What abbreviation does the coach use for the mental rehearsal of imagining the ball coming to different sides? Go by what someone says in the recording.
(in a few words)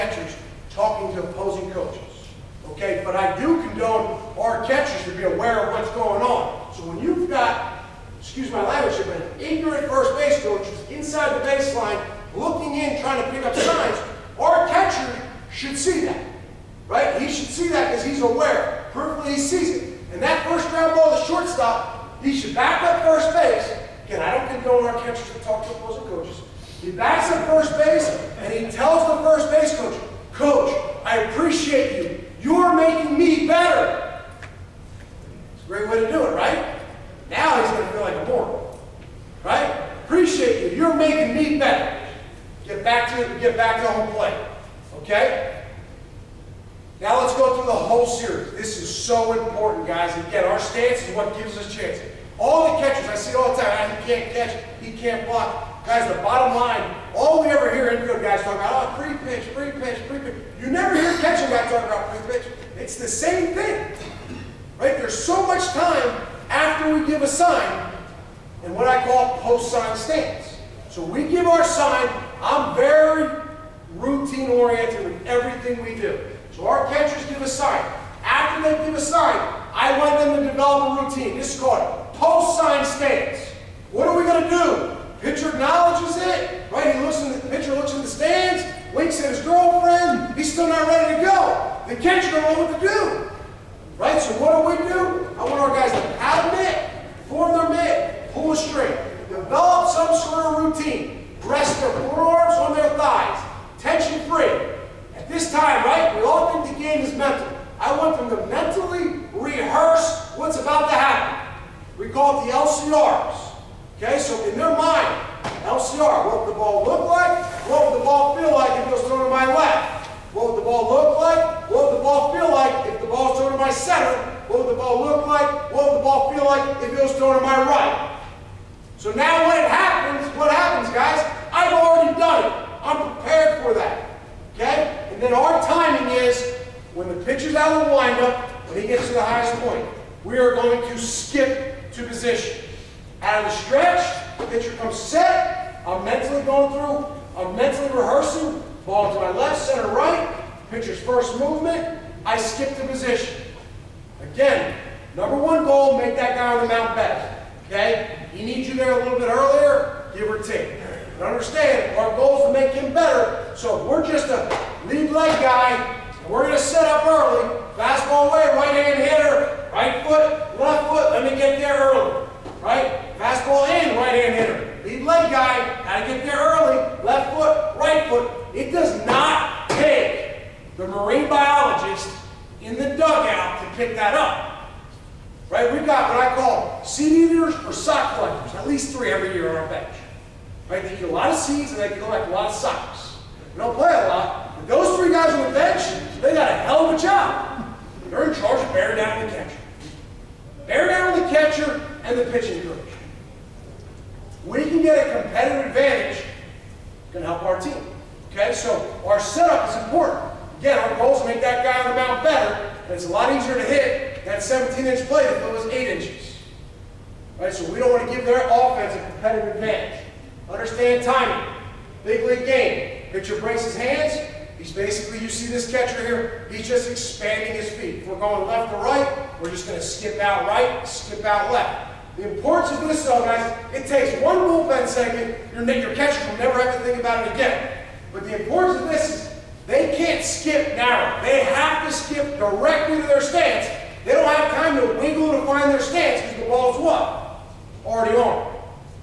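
LCRs.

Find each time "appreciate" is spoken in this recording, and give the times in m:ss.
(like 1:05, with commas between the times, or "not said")
0:31, 0:40.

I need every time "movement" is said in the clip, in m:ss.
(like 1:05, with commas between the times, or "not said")
2:31, 3:54.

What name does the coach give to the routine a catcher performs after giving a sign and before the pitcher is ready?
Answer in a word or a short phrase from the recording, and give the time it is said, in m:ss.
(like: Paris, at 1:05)
Post-sign stance, at 1:09.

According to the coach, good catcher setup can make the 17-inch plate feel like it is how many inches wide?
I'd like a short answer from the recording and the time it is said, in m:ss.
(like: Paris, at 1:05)
8 inches, at 3:35.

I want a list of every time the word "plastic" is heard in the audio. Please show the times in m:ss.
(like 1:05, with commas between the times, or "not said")
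not said.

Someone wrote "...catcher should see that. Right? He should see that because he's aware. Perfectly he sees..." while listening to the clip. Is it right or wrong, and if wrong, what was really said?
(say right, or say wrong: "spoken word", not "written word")
right.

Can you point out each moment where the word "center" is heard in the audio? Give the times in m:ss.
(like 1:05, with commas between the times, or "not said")
2:03, 2:29.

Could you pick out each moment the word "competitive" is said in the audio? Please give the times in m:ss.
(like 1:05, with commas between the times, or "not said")
3:25, 3:39.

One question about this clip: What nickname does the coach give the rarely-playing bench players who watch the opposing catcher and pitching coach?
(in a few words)
Seed eaters.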